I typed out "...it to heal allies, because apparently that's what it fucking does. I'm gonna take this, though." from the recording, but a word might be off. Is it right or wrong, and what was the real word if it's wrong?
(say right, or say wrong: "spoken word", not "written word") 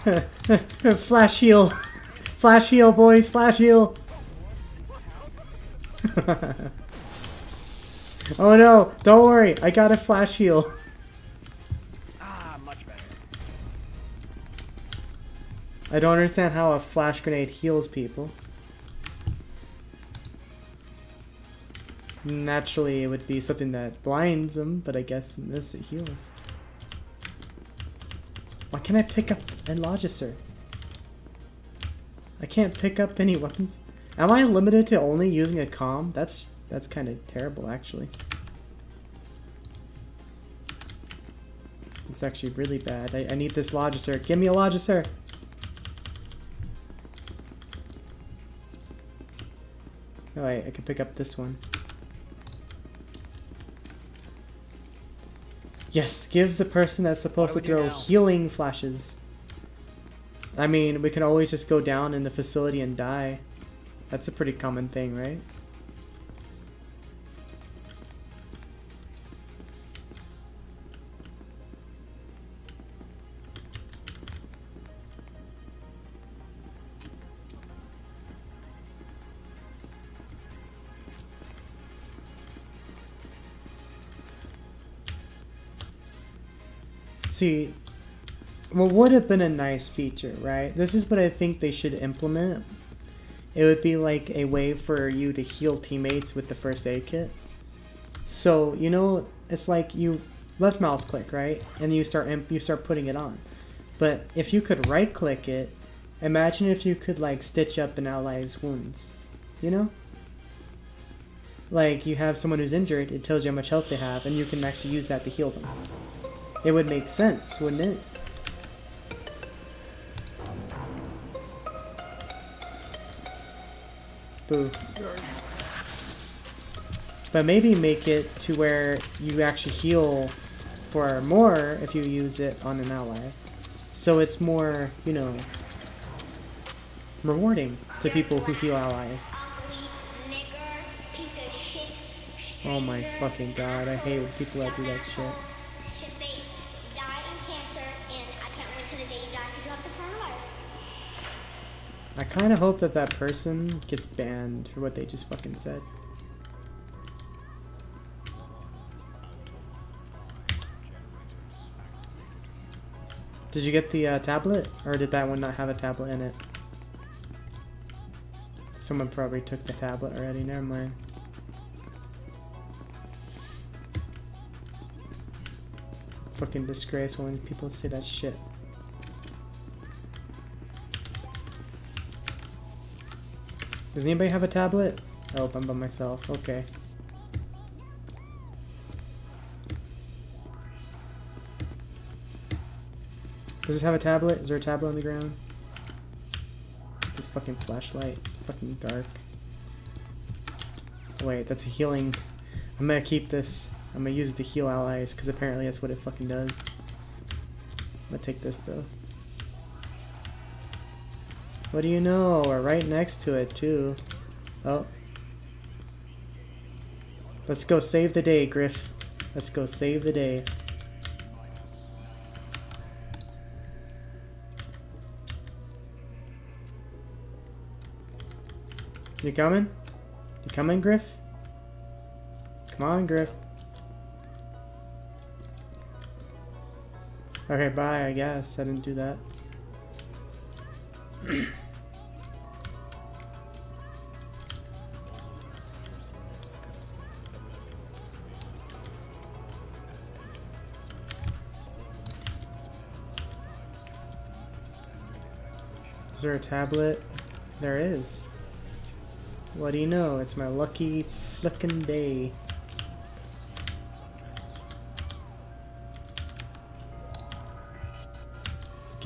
right.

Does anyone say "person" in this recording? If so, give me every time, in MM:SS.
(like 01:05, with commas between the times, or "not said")
00:56, 02:33.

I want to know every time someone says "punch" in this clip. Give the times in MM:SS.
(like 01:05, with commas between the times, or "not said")
not said.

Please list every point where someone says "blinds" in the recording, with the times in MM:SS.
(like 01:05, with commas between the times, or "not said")
00:24.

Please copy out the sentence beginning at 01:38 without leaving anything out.
So, you know, it's like you left mouse click, right?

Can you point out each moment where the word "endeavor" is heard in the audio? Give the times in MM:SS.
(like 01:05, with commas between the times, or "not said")
not said.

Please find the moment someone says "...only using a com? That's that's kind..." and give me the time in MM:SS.
00:34.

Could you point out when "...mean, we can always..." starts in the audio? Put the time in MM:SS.
01:00.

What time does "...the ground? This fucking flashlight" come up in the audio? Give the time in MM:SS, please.
03:14.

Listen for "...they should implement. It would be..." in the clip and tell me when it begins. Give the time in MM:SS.
01:31.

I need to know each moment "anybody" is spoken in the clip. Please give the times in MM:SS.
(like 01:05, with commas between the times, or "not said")
03:04.